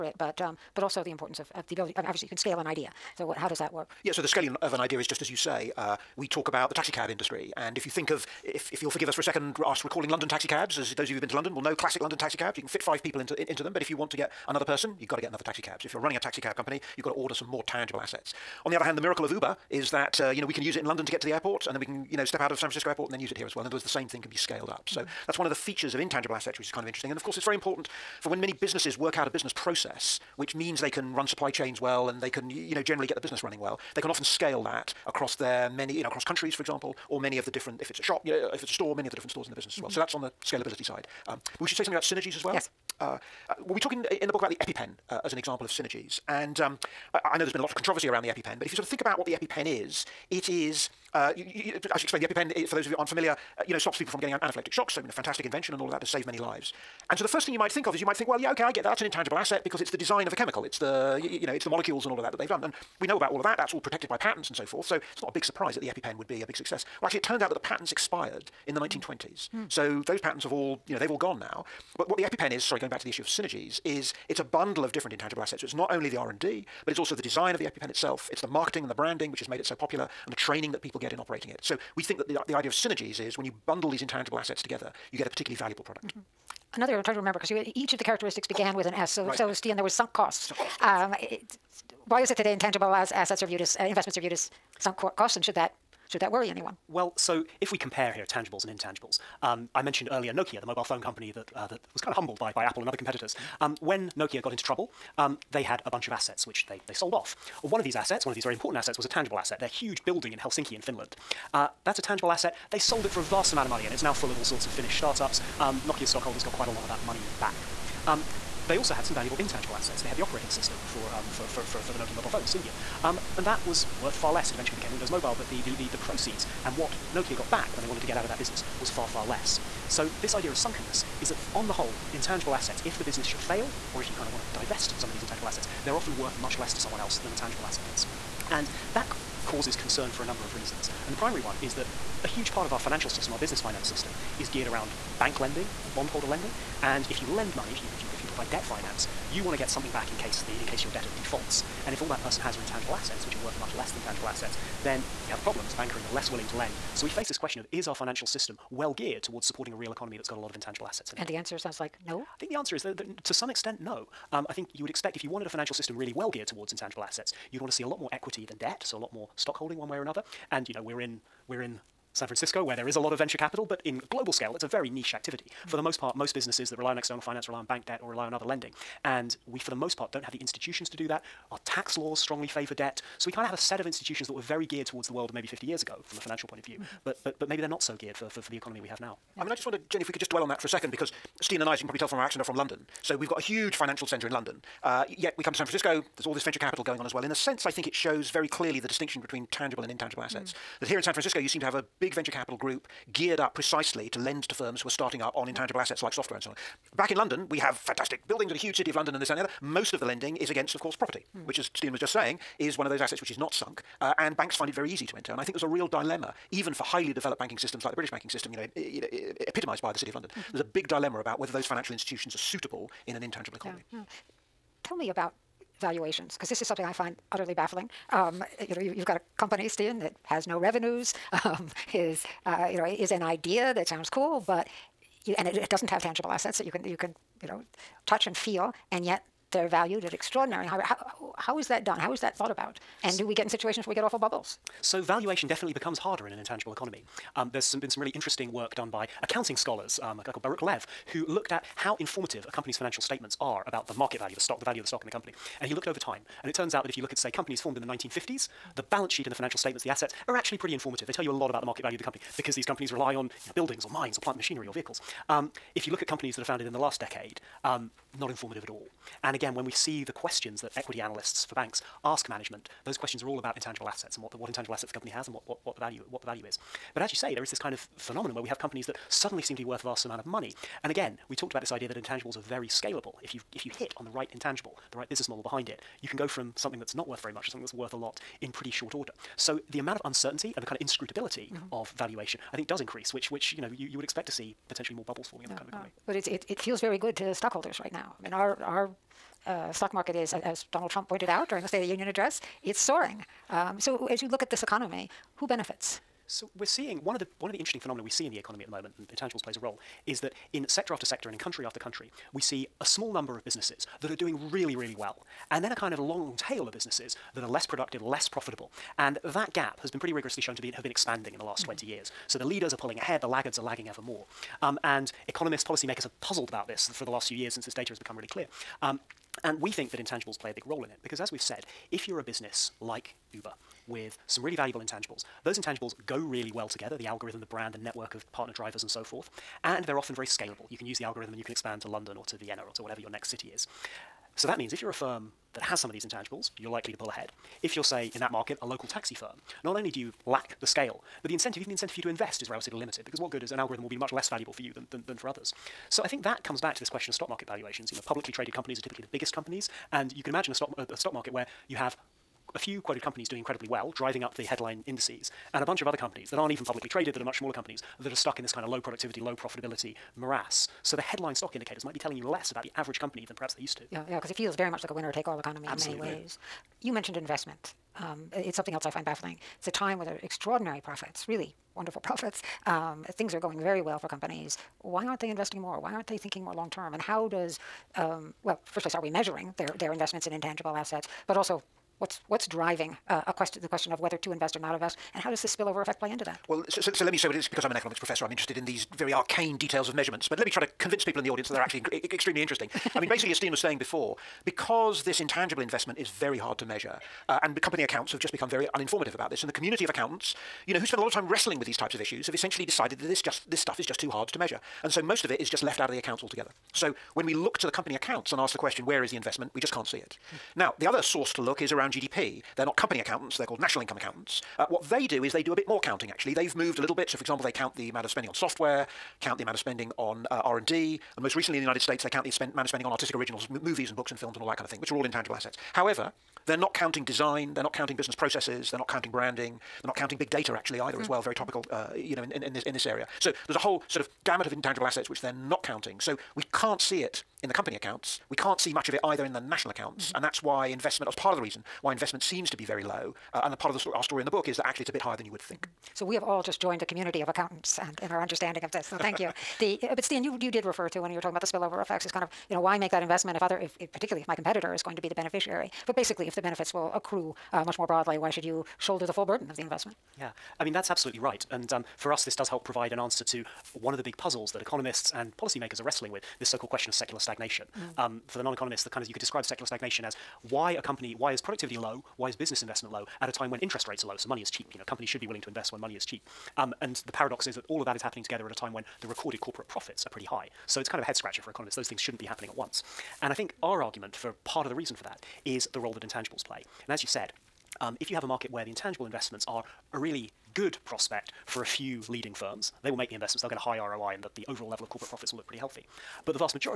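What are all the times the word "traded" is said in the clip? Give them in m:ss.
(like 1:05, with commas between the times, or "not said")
5:58, 6:06.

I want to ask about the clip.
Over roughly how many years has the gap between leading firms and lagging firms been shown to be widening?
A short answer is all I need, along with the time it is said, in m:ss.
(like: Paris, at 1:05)
20 years, at 5:21.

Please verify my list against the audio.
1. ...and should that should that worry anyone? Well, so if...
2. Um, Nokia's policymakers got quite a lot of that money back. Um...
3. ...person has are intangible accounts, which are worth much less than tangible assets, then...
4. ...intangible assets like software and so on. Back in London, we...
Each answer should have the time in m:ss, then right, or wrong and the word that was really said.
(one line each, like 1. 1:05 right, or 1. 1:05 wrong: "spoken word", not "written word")
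1. 1:35 right
2. 1:55 wrong: "stockholders", not "policymakers"
3. 2:32 wrong: "assets", not "accounts"
4. 3:25 right.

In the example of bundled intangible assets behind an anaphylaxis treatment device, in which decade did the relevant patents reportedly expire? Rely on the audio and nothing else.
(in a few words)
1920s.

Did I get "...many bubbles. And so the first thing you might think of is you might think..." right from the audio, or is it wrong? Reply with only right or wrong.
wrong.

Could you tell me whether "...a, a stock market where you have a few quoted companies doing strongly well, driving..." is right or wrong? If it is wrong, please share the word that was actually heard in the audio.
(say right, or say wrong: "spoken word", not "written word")
wrong: "incredibly", not "strongly".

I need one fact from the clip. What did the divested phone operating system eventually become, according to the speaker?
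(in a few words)
Windows Mobile.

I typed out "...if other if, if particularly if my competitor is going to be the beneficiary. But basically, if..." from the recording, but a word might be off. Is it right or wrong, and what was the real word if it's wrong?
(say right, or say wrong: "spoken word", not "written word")
right.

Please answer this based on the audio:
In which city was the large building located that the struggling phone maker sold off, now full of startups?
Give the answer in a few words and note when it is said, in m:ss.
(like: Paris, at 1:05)
Helsinki, at 1:50.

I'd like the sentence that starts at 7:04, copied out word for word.
Uh, what they do is they do a bit more counting, actually.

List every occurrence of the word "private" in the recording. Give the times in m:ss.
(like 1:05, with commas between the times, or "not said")
not said.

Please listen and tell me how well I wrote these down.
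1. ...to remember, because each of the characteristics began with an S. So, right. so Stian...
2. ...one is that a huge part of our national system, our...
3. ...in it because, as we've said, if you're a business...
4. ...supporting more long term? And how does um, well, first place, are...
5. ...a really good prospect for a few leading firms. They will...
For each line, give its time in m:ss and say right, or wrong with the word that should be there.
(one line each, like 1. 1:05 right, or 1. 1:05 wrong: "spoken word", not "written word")
1. 1:27 right
2. 2:21 wrong: "financial", not "national"
3. 5:30 right
4. 6:26 wrong: "thinking", not "supporting"
5. 8:19 right.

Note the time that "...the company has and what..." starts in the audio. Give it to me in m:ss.
4:34.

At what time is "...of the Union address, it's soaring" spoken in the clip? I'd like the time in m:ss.
5:01.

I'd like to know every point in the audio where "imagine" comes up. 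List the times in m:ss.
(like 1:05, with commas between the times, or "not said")
6:00.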